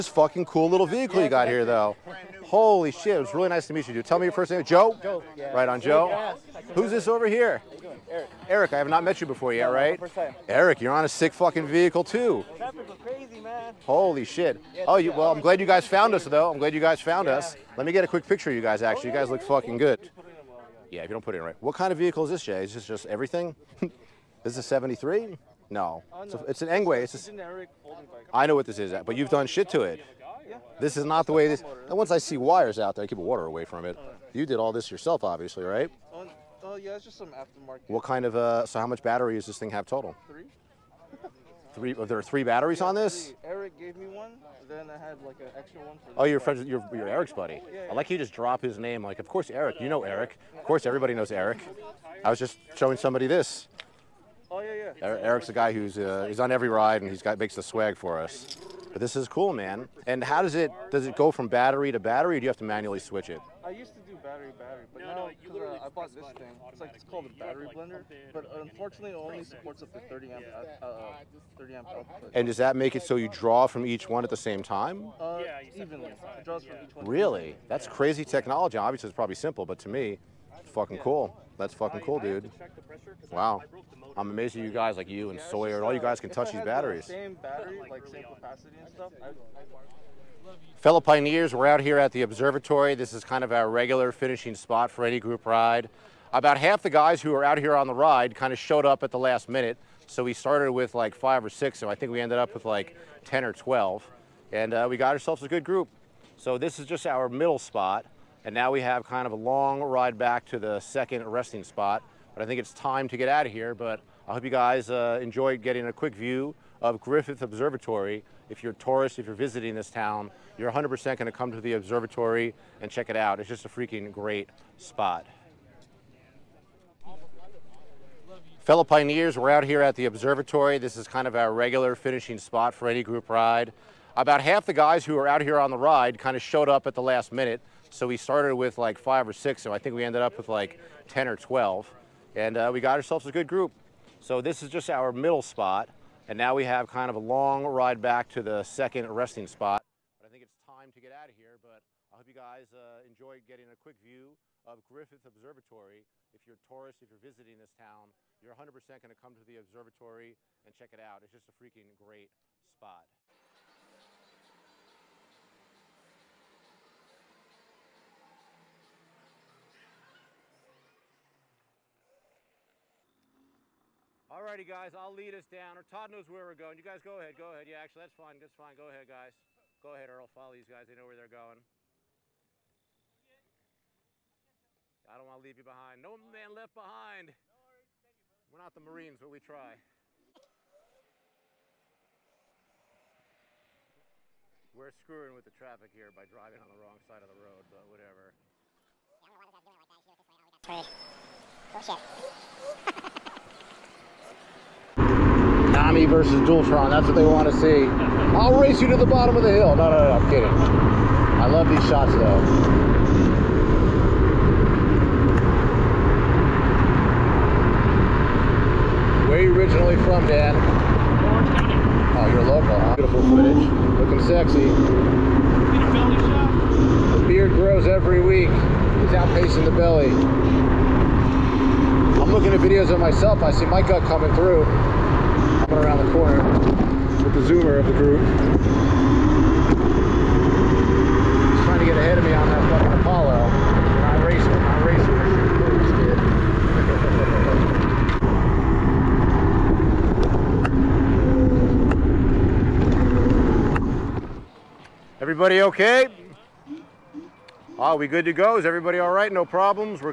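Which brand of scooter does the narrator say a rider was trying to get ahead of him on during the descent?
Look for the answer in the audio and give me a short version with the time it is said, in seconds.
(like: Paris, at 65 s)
Apollo, at 242 s.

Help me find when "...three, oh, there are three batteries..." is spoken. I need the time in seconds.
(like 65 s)
41 s.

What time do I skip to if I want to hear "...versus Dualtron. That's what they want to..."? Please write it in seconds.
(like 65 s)
206 s.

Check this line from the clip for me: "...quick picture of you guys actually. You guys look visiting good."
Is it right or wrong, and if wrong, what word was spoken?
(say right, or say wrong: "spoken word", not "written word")
wrong: "fucking", not "visiting".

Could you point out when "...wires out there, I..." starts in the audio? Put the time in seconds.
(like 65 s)
32 s.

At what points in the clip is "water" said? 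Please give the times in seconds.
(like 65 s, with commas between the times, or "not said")
33 s.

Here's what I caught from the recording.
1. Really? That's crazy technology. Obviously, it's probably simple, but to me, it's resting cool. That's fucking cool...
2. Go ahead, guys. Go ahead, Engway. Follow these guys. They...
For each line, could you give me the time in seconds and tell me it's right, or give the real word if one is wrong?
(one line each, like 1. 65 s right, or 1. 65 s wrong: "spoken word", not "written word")
1. 77 s wrong: "fucking", not "resting"
2. 178 s wrong: "Earl", not "Engway".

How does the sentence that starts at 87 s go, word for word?
Same battery, like same capacity and stuff.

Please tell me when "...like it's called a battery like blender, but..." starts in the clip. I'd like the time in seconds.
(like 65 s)
66 s.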